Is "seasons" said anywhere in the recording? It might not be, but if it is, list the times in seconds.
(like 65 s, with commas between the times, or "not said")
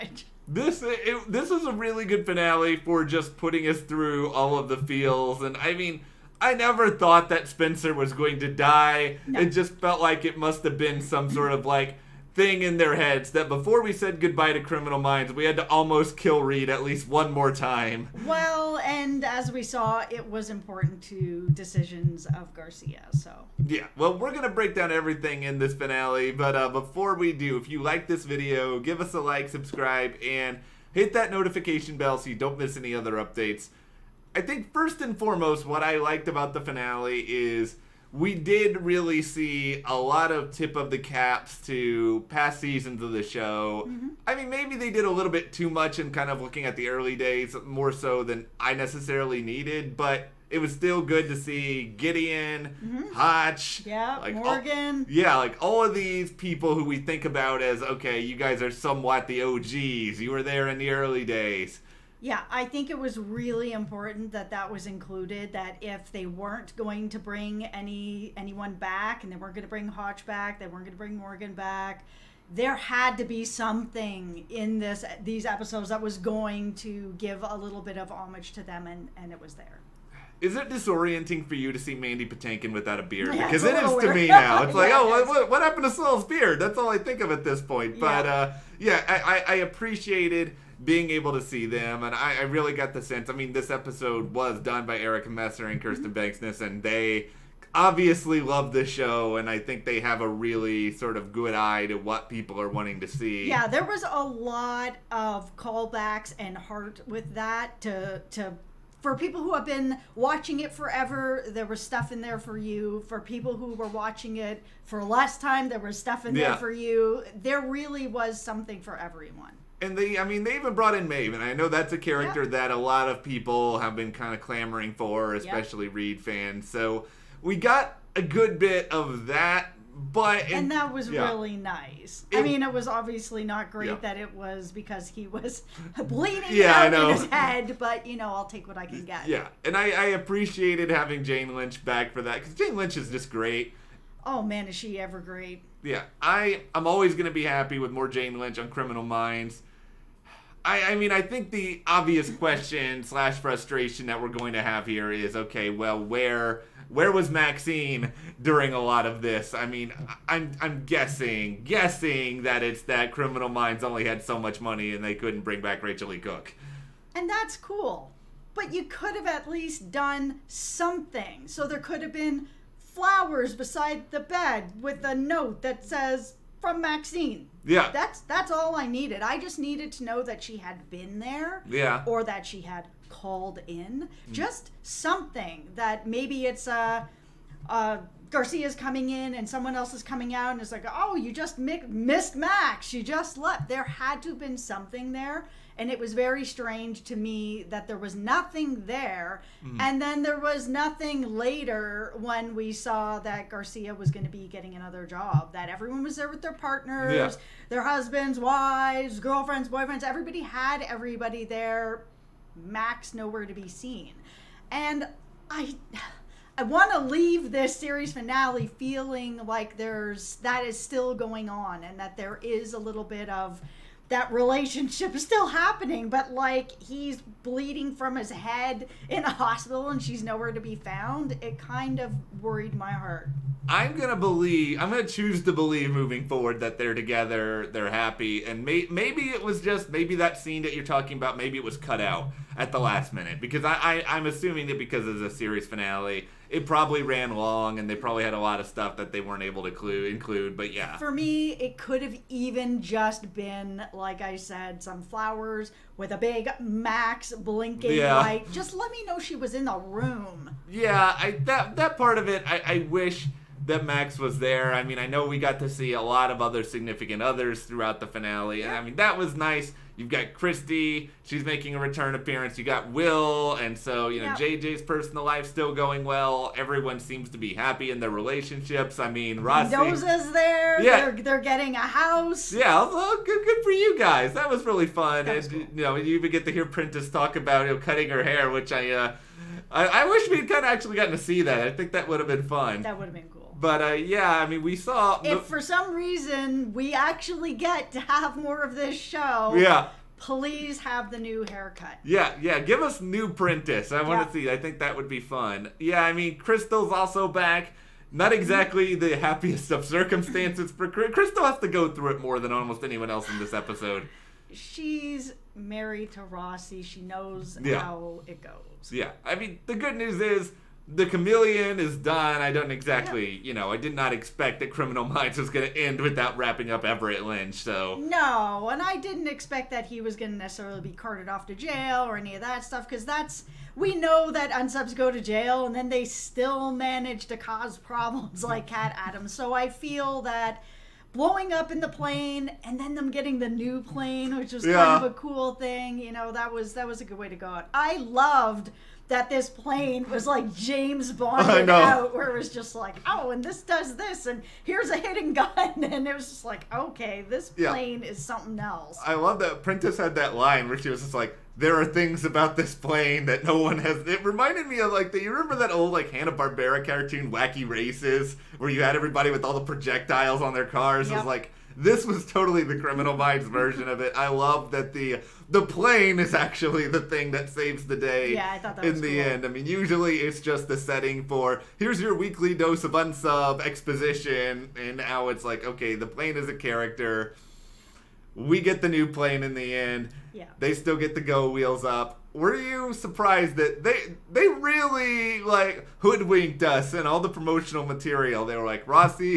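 42 s.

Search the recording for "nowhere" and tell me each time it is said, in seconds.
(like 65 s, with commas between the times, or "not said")
213 s, 230 s.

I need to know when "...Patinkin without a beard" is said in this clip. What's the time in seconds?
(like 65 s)
82 s.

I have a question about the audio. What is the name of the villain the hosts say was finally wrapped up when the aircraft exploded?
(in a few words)
Everett Lynch.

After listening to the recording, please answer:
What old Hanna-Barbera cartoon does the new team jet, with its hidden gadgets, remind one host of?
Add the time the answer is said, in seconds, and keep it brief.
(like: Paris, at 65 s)
Wacky Races, at 367 s.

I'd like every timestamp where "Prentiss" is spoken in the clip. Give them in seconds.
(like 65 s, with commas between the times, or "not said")
286 s, 303 s, 359 s.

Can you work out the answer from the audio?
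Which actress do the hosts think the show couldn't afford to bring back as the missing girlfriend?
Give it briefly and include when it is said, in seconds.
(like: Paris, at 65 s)
Rachel E. Cook, at 165 s.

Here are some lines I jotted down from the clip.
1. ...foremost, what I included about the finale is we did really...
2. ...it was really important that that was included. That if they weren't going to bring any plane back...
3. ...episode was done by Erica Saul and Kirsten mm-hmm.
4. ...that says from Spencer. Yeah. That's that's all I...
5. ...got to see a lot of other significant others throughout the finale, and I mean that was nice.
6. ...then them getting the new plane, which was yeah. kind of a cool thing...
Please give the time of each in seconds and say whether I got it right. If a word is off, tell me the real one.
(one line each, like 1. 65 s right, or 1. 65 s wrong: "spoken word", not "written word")
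1. 35 s wrong: "liked", not "included"
2. 62 s wrong: "anyone", not "plane"
3. 93 s wrong: "Messer", not "Saul"
4. 175 s wrong: "Maxine", not "Spencer"
5. 265 s right
6. 342 s right.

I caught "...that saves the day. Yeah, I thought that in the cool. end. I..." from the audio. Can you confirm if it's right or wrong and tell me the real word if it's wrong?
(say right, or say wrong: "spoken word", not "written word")
right.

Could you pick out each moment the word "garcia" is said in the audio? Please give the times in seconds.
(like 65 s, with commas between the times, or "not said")
22 s, 188 s, 203 s.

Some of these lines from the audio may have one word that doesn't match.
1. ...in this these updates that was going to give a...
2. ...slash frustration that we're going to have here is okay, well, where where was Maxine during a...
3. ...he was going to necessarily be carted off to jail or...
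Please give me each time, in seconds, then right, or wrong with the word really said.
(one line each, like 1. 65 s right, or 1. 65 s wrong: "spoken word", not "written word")
1. 74 s wrong: "episodes", not "updates"
2. 153 s right
3. 329 s right.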